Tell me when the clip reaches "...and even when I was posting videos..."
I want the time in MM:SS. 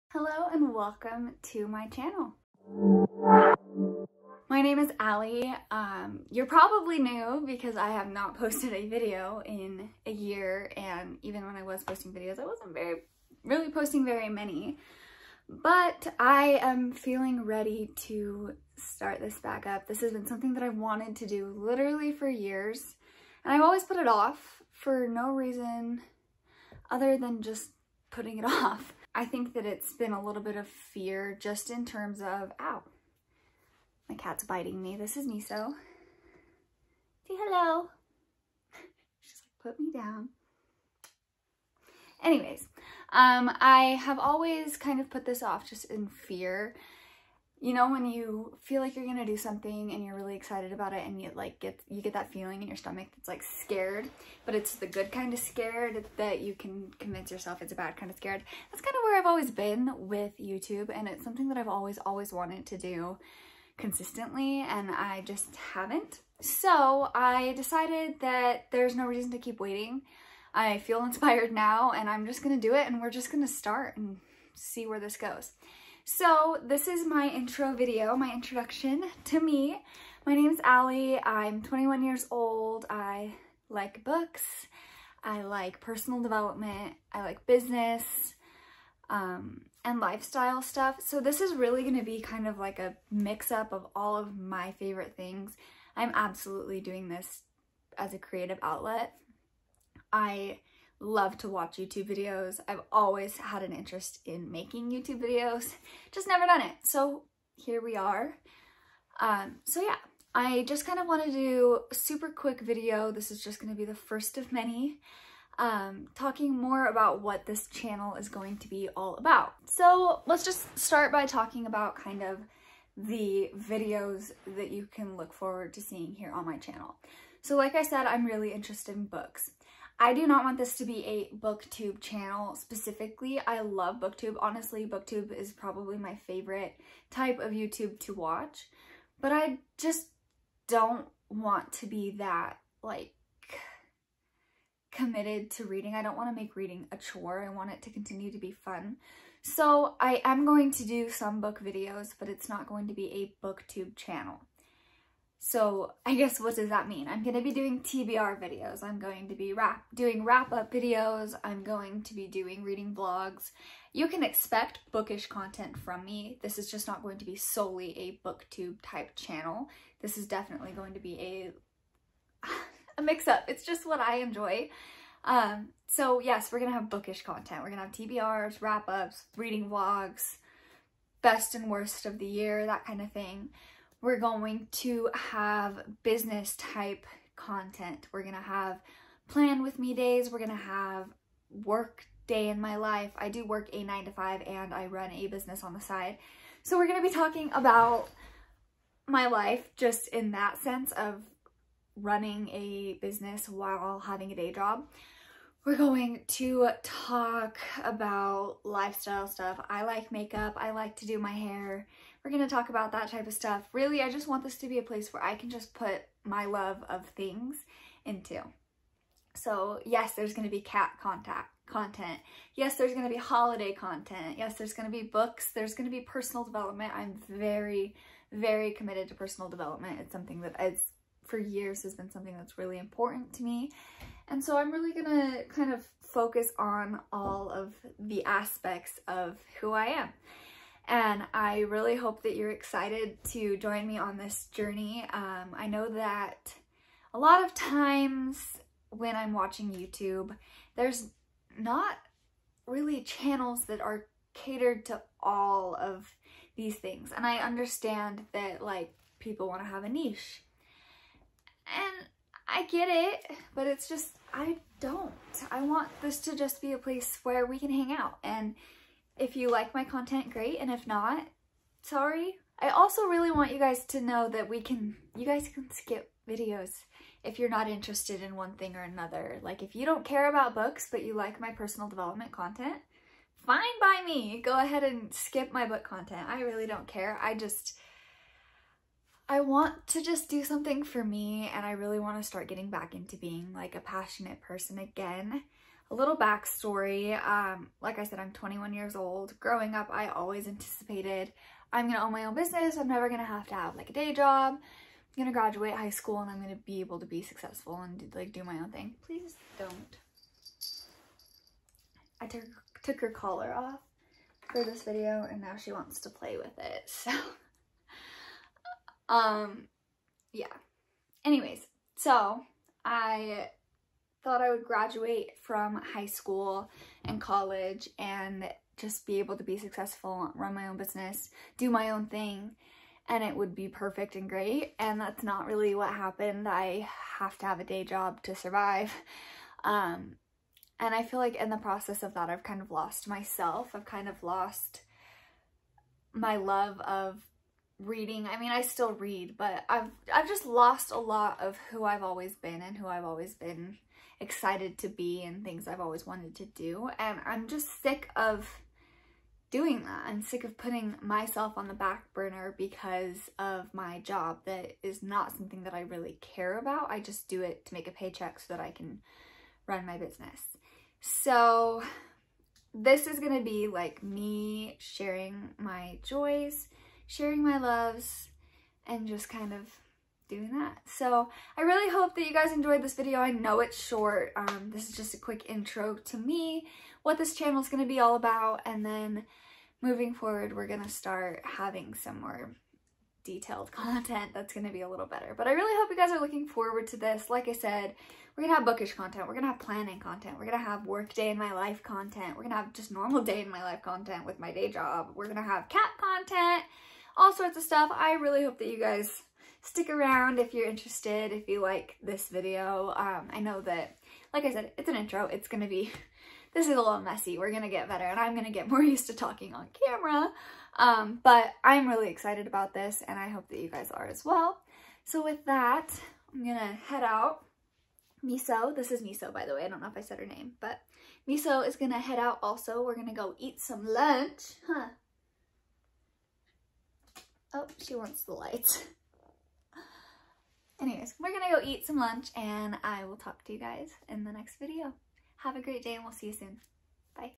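00:10.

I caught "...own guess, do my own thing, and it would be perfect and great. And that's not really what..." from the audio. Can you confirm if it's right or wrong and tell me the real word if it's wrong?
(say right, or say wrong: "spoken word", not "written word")
wrong: "business", not "guess".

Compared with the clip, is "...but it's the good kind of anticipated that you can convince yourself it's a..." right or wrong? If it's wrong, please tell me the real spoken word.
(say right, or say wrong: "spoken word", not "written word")
wrong: "scared", not "anticipated".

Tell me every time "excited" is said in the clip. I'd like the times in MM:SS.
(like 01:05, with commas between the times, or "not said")
00:50, 04:02, 05:54, 07:02.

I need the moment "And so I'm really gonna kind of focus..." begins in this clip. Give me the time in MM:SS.
03:54.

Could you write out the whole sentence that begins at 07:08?
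Miso, this is Miso by the way, I don't know if I said her name, but Miso is gonna head out also.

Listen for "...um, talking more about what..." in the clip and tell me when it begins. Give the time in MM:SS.
01:55.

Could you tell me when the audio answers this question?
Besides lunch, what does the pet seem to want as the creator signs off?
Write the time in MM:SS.
07:18.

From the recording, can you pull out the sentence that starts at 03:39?
So yes, there's going to be cat contact content.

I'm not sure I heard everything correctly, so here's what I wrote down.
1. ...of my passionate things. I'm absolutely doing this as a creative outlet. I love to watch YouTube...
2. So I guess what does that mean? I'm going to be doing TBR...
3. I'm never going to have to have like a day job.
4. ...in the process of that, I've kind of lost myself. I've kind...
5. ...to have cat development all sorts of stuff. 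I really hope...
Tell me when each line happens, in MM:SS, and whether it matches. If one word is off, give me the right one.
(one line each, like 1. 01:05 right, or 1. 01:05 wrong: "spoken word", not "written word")
1. 01:34 wrong: "favorite", not "passionate"
2. 02:35 right
3. 05:02 right
4. 05:41 right
5. 06:45 wrong: "content", not "development".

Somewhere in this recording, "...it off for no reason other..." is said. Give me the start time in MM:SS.
00:23.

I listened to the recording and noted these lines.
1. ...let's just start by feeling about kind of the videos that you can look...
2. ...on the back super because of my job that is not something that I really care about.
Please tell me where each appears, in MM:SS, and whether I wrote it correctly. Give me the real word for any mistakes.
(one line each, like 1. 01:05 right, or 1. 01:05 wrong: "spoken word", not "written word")
1. 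02:00 wrong: "talking", not "feeling"
2. 06:01 wrong: "burner", not "super".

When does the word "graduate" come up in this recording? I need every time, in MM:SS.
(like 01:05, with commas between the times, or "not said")
05:05, 05:24.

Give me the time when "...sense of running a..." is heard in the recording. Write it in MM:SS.
03:20.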